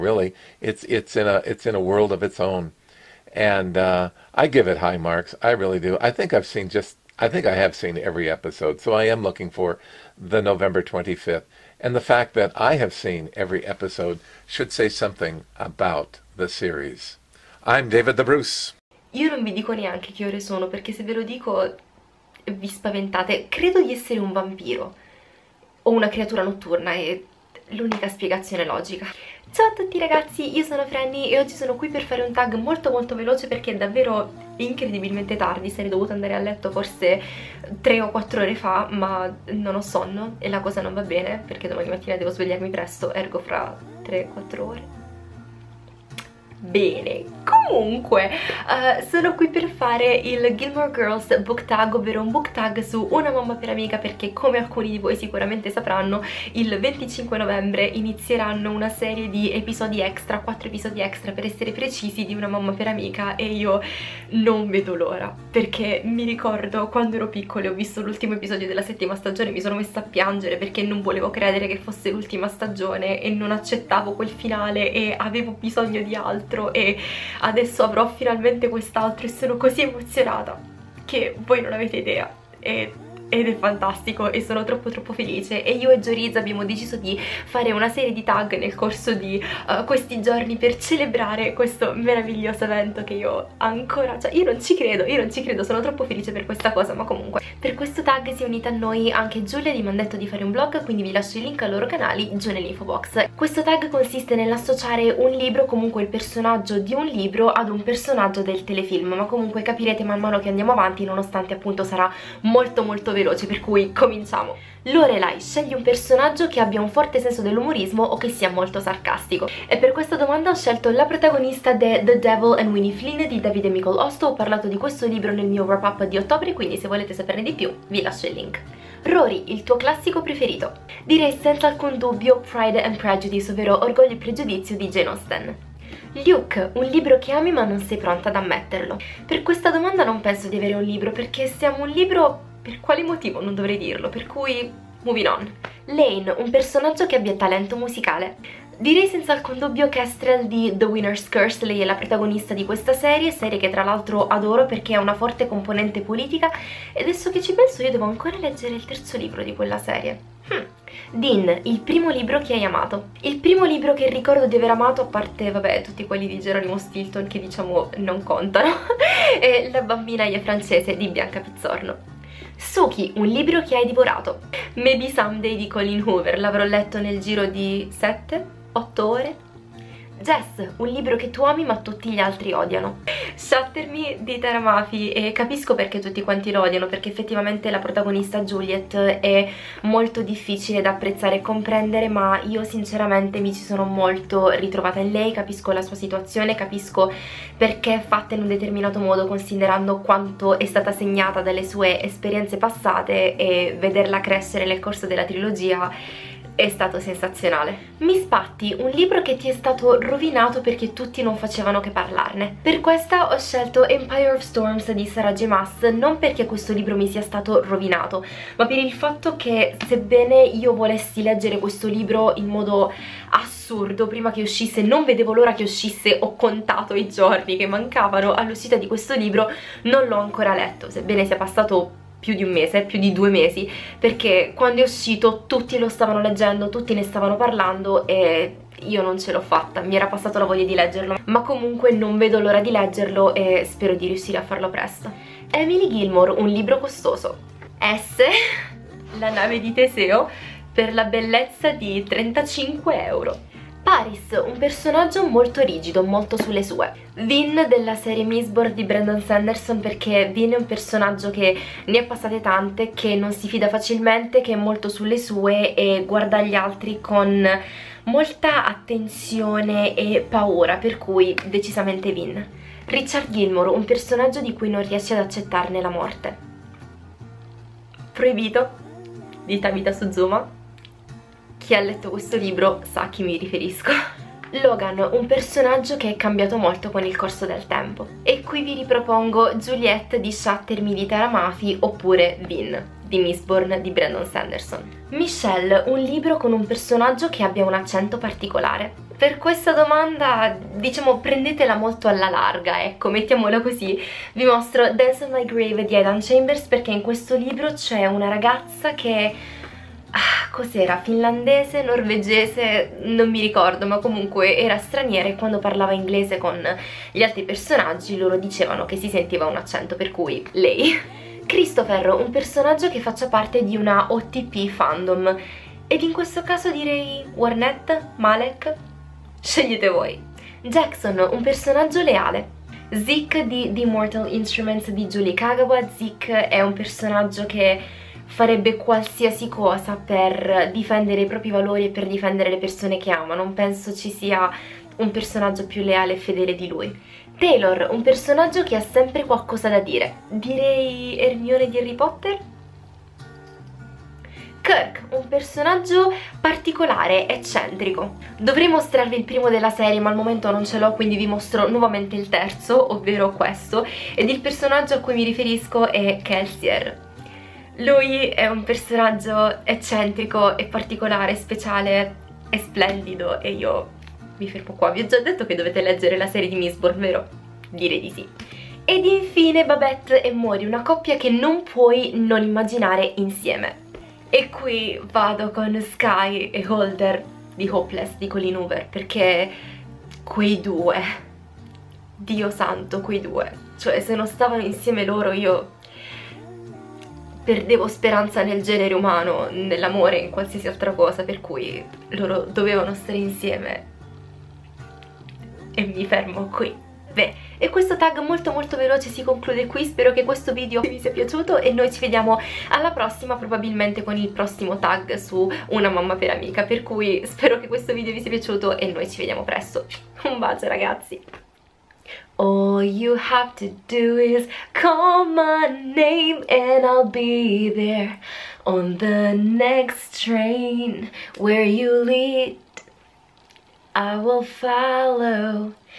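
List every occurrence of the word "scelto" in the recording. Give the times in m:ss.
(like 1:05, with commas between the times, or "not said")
2:00, 3:33.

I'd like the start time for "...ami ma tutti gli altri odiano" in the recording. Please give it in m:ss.
3:01.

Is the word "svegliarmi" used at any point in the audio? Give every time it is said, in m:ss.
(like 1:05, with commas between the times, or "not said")
0:42.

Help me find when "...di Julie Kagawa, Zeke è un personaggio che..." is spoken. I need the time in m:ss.
5:34.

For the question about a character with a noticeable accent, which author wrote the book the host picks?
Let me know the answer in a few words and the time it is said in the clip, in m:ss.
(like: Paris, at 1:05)
Aidan Chambers, at 5:05.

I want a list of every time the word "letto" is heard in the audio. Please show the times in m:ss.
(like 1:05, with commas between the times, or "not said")
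0:36, 2:56, 3:50, 4:41.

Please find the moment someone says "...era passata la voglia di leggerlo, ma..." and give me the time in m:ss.
3:59.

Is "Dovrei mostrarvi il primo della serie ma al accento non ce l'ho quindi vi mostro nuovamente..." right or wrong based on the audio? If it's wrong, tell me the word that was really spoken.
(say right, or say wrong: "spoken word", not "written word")
wrong: "momento", not "accento".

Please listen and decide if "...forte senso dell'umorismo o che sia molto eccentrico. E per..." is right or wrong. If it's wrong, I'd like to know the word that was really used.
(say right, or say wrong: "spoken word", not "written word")
wrong: "sarcastico", not "eccentrico".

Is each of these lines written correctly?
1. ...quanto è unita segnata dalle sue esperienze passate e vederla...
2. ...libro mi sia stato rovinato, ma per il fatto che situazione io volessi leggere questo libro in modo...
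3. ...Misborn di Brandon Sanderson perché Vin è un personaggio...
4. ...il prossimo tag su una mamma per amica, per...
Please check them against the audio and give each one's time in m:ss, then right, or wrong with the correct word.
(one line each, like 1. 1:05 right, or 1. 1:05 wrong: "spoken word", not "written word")
1. 3:19 wrong: "stata", not "unita"
2. 3:36 wrong: "sebbene", not "situazione"
3. 4:18 right
4. 6:54 right.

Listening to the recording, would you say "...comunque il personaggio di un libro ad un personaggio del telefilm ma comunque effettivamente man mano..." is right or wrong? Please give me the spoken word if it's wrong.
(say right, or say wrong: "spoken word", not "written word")
wrong: "capirete", not "effettivamente".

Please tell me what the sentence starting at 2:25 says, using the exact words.
Lane, un personaggio che abbia talento musicale.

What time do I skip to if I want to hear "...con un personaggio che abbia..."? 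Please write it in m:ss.
4:56.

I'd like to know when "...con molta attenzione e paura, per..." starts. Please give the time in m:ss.
4:27.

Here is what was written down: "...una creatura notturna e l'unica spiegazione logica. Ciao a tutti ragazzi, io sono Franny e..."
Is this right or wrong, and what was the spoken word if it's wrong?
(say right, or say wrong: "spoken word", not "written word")
right.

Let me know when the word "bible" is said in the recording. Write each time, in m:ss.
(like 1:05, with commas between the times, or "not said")
not said.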